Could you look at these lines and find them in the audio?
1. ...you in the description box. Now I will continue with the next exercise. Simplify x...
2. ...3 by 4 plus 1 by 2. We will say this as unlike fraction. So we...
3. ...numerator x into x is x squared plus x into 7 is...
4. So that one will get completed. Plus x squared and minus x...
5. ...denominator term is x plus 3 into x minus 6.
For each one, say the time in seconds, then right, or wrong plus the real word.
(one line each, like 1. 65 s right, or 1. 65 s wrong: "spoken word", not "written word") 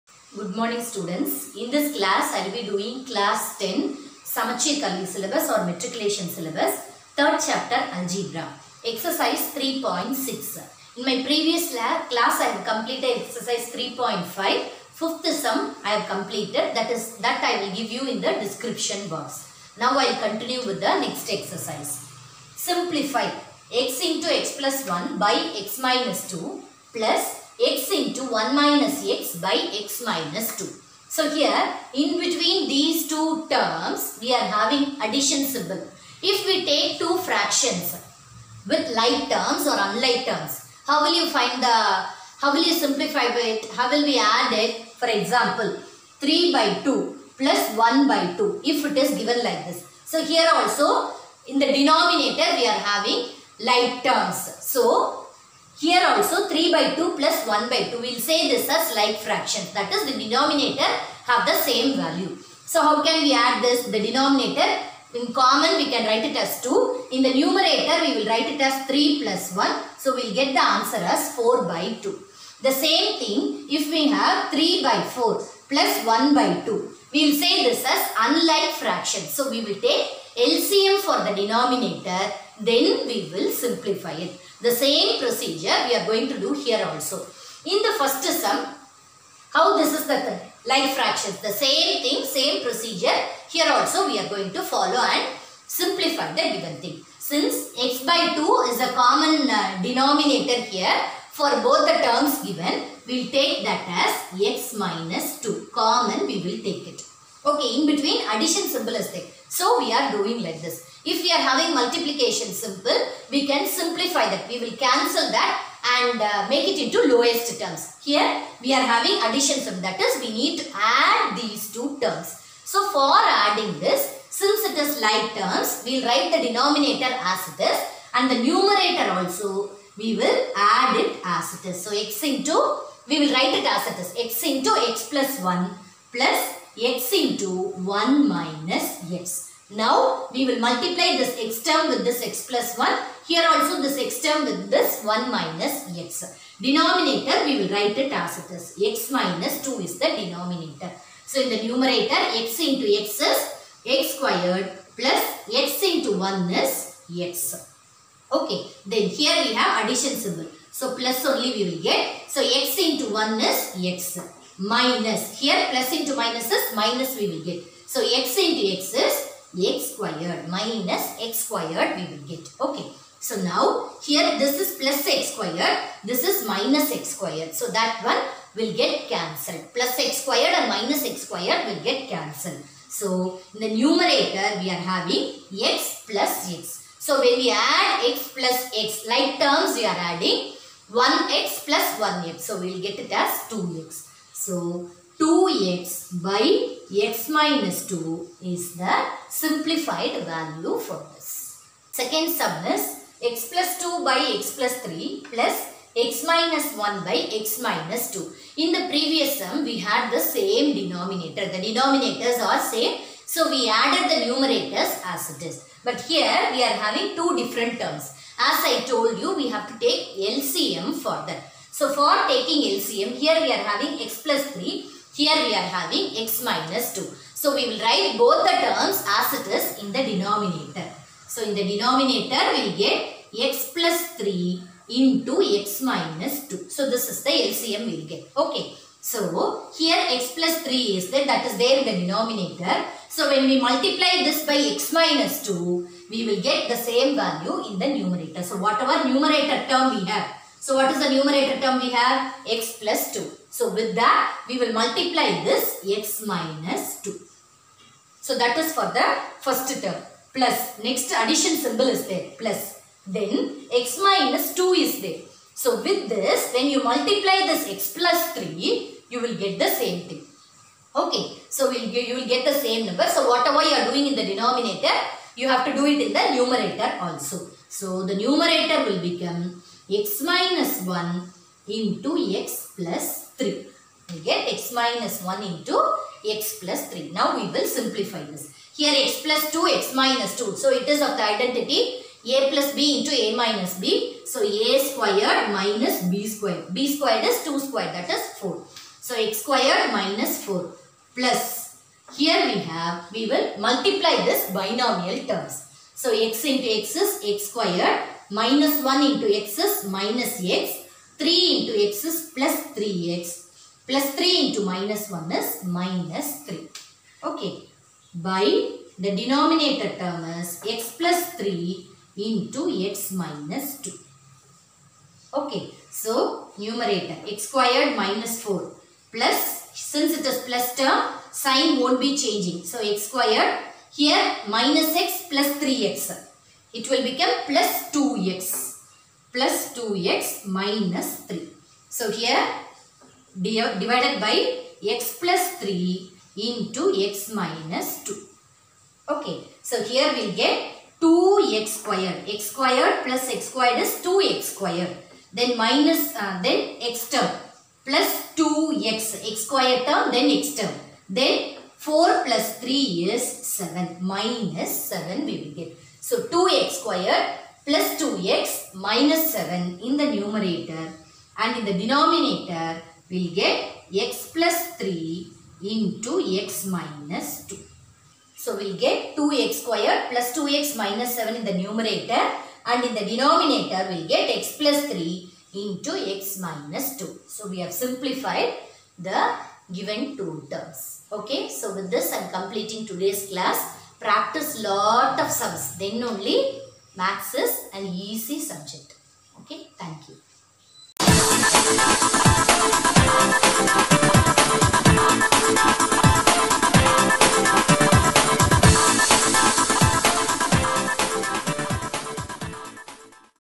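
1. 17 s right
2. 74 s right
3. 151 s wrong: "1", not "7"
4. 177 s wrong: "cancelled", not "completed"
5. 319 s wrong: "2", not "6".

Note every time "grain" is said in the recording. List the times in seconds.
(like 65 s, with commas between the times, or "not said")
not said.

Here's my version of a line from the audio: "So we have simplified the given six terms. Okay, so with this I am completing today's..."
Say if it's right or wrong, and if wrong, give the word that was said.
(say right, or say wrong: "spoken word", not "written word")
wrong: "two", not "six".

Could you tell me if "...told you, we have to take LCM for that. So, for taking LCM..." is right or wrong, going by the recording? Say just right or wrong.
right.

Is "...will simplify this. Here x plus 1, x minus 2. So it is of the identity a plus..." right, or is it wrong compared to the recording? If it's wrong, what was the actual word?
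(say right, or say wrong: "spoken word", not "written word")
wrong: "2", not "1".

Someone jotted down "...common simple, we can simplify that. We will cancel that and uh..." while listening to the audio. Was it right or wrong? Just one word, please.
wrong.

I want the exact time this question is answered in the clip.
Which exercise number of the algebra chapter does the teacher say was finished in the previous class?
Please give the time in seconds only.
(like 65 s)
13 s.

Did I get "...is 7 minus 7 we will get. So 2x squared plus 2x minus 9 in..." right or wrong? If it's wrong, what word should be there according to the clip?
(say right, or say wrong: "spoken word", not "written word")
wrong: "7", not "9".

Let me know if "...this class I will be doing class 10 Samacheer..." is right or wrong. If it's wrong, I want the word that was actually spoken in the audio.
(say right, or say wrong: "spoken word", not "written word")
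right.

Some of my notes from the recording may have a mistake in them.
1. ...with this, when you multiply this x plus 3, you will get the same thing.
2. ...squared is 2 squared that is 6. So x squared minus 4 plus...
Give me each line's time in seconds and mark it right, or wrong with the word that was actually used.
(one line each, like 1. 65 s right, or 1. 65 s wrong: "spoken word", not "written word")
1. 265 s right
2. 296 s wrong: "4", not "6".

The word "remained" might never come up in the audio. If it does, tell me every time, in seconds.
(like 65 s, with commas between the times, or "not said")
not said.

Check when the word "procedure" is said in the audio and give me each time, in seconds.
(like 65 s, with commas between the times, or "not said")
85 s, 92 s.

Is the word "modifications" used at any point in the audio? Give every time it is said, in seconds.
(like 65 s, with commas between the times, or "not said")
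not said.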